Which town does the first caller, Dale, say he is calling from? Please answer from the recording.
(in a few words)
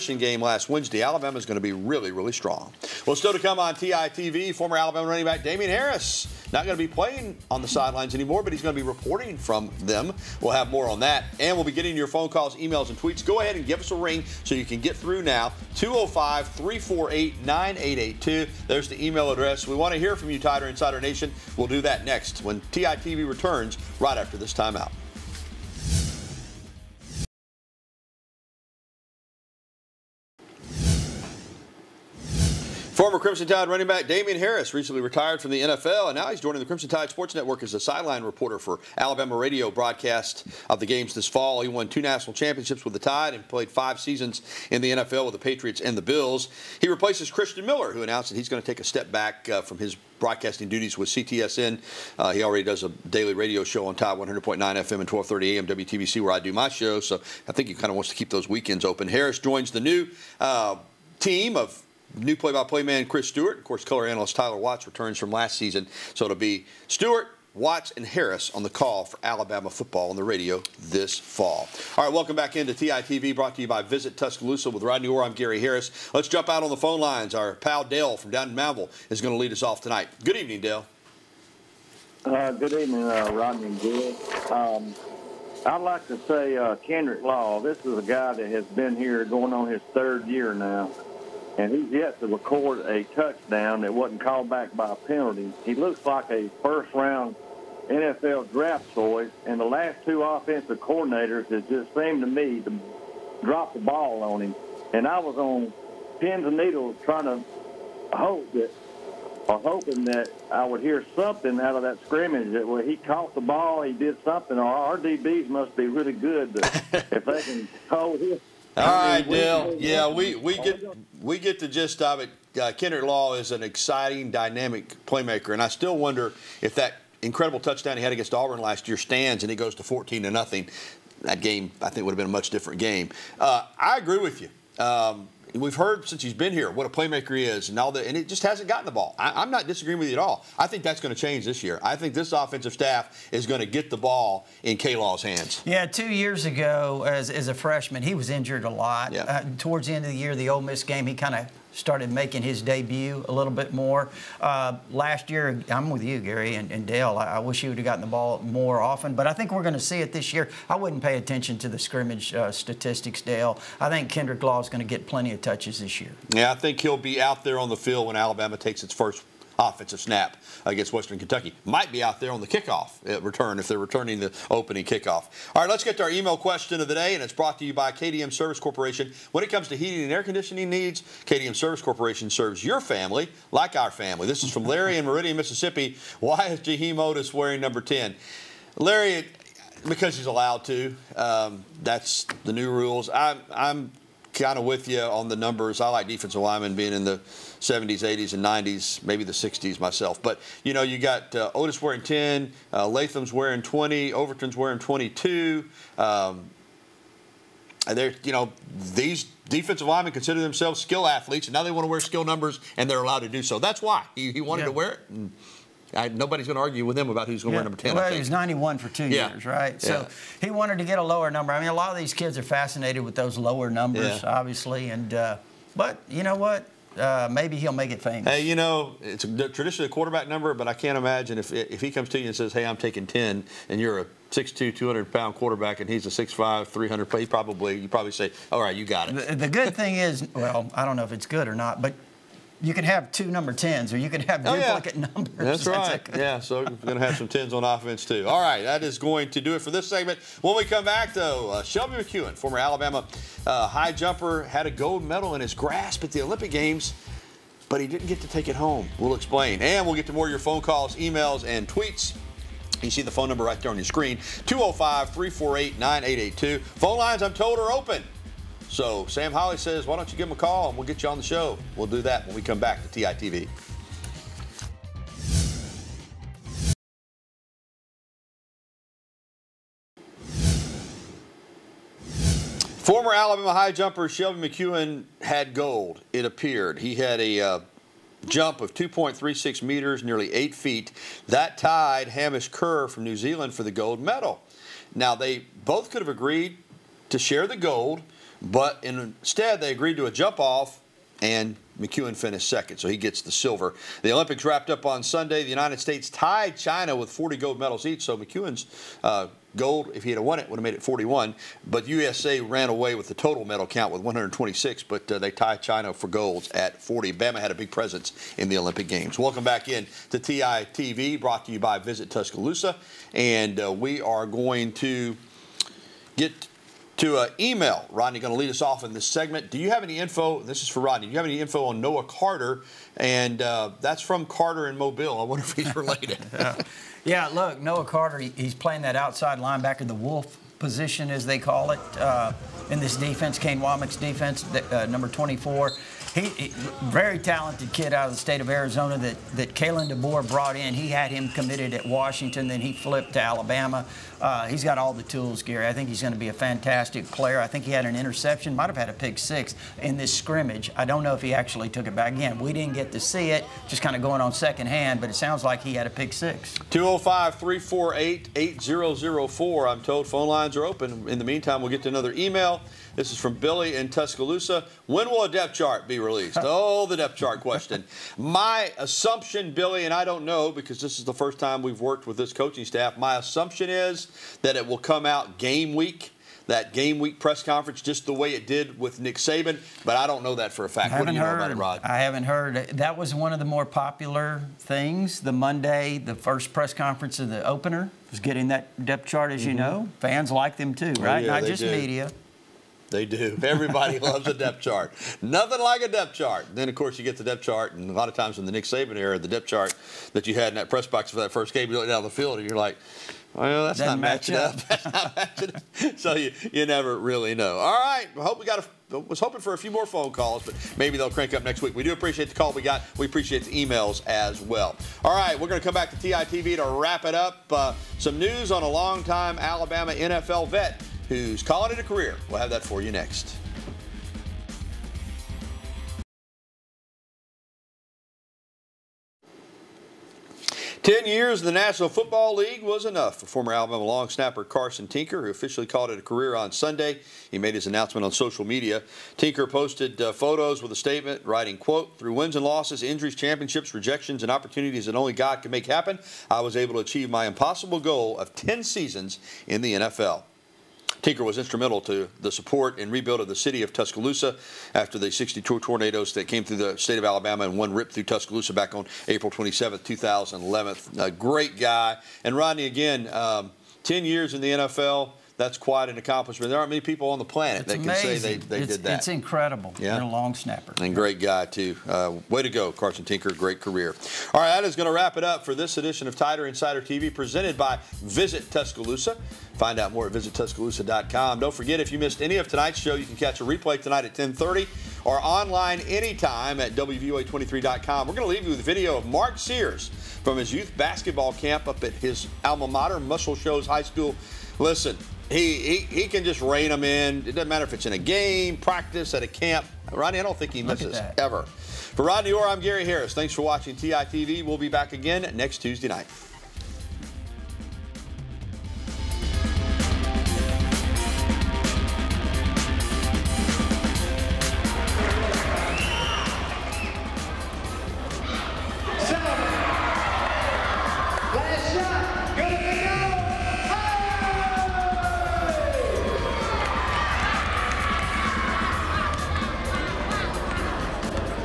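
Moundville.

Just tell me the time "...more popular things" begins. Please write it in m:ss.
6:33.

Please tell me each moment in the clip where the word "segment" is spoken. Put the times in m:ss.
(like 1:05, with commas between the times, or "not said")
4:09, 5:29.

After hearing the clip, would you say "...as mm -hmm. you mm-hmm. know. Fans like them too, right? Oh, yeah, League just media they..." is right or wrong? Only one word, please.
wrong.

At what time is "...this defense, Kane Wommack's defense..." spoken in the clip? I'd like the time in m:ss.
5:42.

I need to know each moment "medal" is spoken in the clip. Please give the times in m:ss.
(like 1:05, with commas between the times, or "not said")
4:15, 4:53, 5:07, 5:13.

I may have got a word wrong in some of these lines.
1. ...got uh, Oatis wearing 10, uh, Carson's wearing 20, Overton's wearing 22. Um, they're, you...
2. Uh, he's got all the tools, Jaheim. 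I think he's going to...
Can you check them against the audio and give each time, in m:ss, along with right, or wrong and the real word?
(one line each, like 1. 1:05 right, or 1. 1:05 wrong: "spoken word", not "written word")
1. 3:20 wrong: "Latham", not "Carson"
2. 5:54 wrong: "Gary", not "Jaheim".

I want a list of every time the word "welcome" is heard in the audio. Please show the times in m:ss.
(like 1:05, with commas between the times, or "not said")
1:12, 5:19.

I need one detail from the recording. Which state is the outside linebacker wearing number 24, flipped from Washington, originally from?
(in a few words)
Arizona.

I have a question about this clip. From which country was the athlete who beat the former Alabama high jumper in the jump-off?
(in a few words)
New Zealand.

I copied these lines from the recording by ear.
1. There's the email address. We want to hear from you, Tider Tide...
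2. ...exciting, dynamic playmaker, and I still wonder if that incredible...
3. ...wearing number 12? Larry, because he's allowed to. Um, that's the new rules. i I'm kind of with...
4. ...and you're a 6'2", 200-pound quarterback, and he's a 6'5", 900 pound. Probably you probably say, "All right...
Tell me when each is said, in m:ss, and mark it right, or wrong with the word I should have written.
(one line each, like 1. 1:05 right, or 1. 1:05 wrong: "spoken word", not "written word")
1. 0:18 wrong: "Insider", not "Tide"
2. 2:03 right
3. 3:07 wrong: "10", not "12"
4. 3:53 wrong: "300", not "900".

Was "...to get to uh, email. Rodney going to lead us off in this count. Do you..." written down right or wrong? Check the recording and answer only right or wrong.
wrong.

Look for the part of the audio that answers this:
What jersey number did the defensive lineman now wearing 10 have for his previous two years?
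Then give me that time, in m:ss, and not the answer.
3:38.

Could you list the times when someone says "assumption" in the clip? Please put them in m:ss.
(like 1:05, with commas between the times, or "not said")
6:18, 6:23.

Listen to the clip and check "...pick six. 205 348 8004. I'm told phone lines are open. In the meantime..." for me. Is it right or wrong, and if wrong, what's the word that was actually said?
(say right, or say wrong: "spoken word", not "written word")
right.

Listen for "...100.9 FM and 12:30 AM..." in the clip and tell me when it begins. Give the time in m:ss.
0:54.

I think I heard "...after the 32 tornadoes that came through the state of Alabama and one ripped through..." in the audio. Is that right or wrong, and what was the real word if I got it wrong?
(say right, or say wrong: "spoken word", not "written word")
wrong: "62", not "32".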